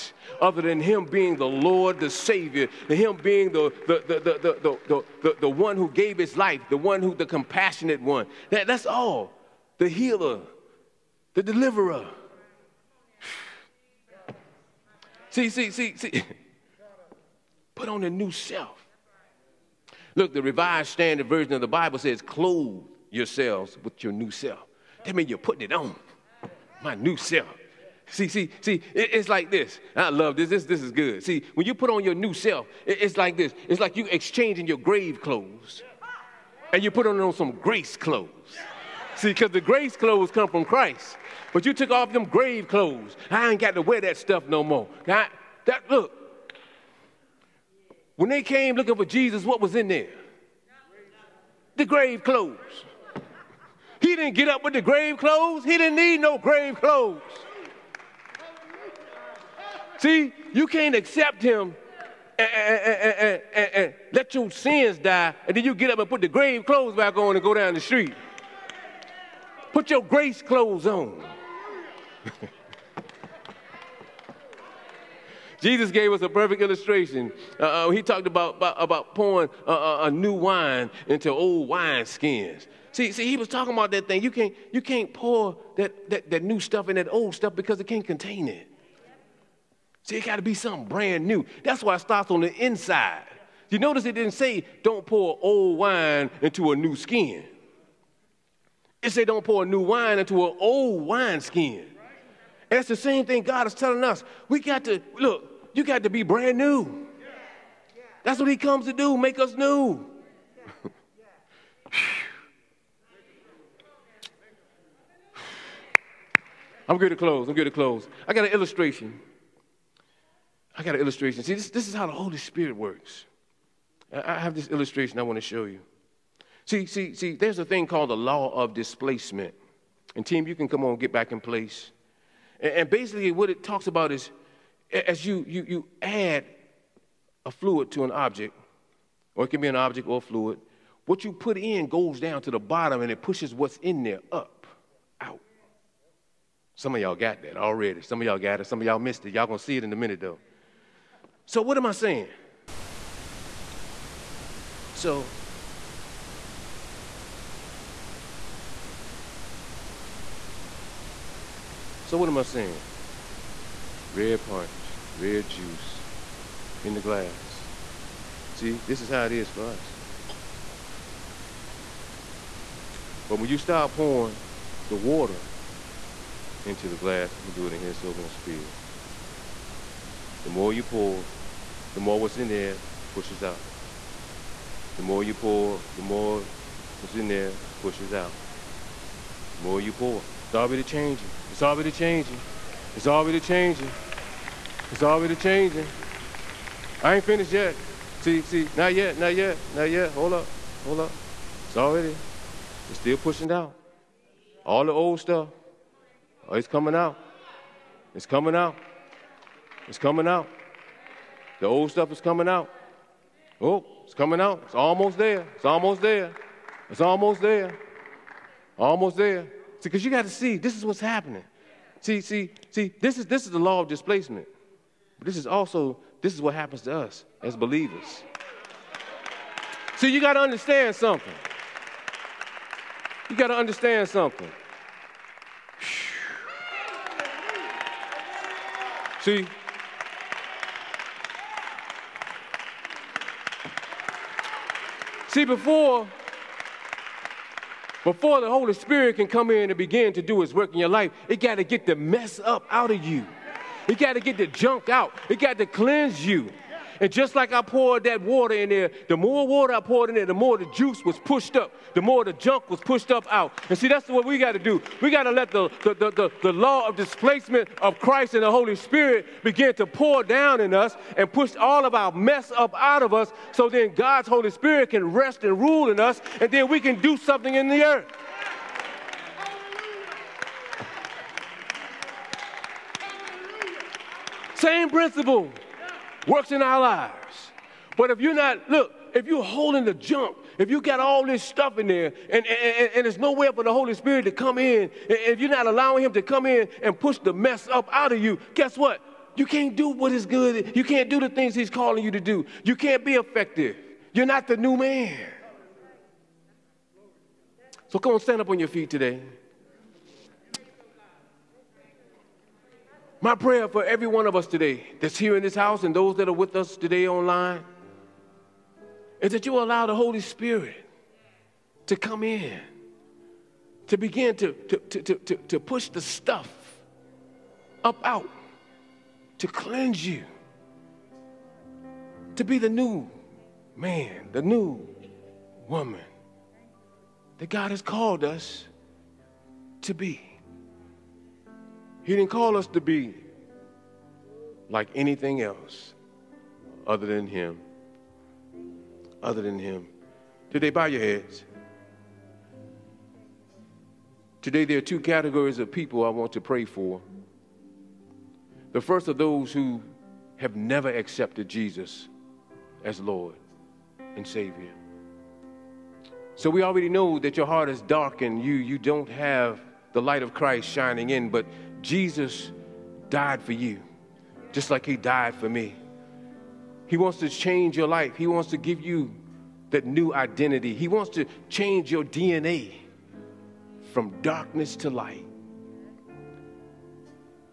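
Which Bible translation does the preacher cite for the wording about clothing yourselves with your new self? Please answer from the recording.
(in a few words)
Revised Standard Version.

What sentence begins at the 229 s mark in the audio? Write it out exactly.
See, you got to understand something.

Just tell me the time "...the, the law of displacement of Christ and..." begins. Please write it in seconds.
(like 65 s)
266 s.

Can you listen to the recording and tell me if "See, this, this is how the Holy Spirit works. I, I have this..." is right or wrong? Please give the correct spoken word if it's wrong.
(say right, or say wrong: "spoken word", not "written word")
right.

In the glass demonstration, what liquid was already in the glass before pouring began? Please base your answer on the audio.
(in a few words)
red punch.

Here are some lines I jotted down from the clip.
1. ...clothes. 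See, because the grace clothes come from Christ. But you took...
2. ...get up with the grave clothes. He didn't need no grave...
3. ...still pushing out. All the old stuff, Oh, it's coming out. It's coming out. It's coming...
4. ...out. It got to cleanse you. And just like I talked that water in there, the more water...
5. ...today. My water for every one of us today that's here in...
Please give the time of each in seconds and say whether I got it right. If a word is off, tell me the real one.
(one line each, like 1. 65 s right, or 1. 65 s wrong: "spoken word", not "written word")
1. 37 s right
2. 54 s right
3. 202 s right
4. 254 s wrong: "poured", not "talked"
5. 308 s wrong: "prayer", not "water".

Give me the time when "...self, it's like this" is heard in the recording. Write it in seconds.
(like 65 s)
32 s.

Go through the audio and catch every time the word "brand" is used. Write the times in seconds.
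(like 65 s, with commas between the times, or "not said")
90 s, 106 s.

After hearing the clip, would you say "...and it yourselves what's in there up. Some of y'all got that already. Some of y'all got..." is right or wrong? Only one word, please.
wrong.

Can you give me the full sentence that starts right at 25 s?
That means you're putting it on.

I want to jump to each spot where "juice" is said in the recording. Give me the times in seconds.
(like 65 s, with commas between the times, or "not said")
165 s, 260 s.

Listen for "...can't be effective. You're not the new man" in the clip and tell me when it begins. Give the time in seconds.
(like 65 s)
302 s.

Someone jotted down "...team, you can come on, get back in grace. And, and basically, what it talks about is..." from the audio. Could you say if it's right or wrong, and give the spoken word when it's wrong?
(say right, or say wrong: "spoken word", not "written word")
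wrong: "place", not "grace".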